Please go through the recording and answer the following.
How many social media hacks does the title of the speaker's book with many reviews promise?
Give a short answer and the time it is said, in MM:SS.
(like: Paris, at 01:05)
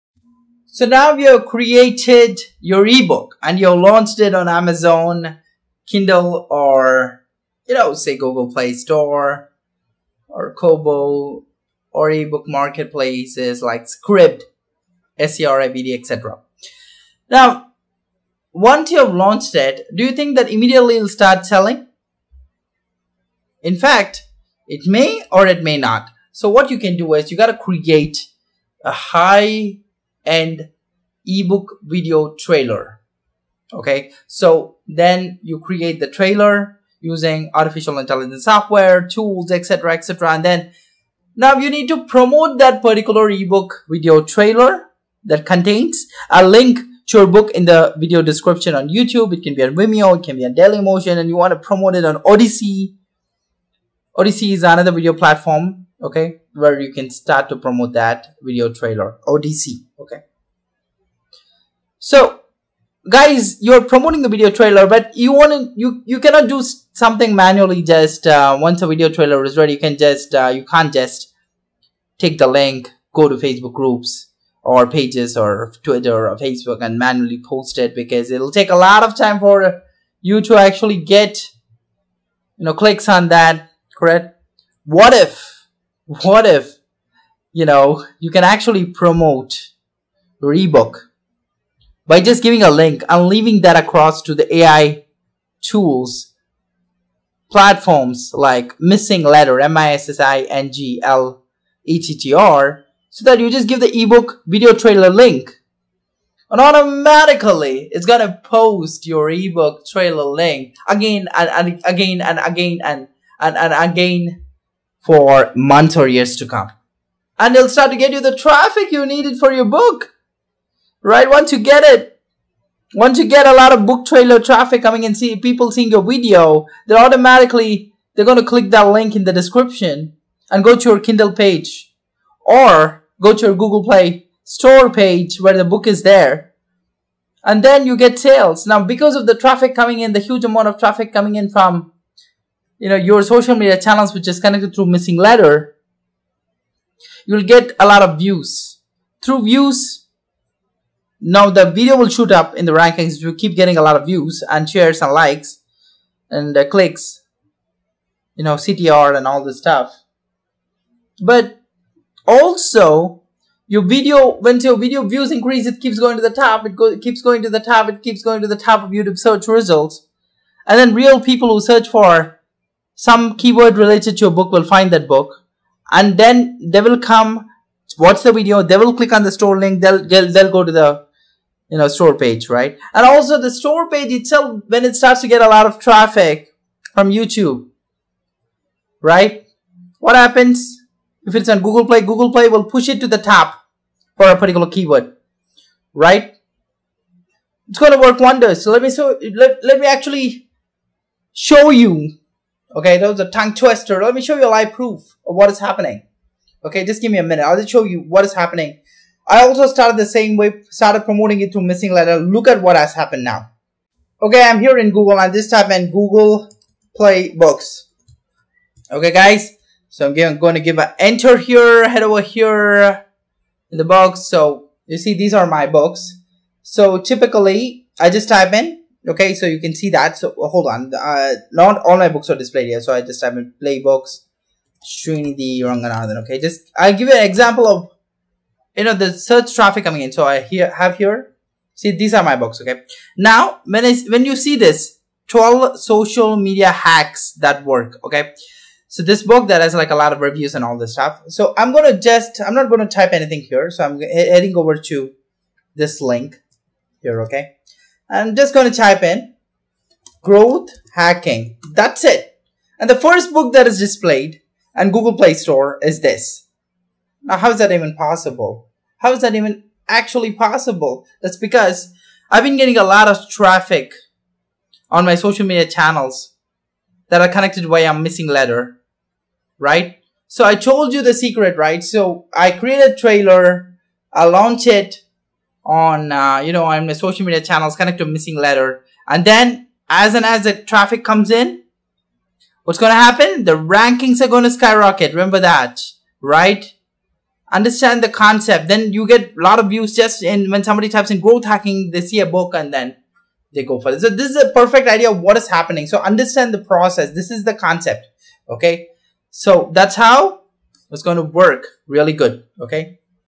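12, at 04:05.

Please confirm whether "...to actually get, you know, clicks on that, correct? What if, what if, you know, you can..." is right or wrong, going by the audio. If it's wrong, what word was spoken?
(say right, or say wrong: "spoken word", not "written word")
right.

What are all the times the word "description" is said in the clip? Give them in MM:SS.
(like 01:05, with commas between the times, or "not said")
00:48, 02:09.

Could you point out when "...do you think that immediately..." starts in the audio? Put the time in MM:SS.
00:19.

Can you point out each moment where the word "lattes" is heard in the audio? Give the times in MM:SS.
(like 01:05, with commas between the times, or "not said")
not said.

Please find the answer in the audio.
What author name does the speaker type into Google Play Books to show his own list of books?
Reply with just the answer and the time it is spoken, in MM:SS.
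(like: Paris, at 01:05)
Srinidhi Ranganathan, at 03:54.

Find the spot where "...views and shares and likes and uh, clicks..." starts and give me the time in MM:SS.
02:34.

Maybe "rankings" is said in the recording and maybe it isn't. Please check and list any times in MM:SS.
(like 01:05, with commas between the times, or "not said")
02:32, 04:53.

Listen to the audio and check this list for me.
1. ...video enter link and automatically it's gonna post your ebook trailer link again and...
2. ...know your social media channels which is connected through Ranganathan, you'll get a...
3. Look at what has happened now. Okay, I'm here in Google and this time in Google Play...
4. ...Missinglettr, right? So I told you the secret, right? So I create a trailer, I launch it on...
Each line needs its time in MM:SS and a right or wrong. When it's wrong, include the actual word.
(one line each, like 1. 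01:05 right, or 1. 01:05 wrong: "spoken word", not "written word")
1. 01:44 wrong: "trailer", not "enter"
2. 02:22 wrong: "Missinglettr", not "Ranganathan"
3. 03:32 right
4. 04:38 right.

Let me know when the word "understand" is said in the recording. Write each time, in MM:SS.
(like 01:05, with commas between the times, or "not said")
04:57, 05:05.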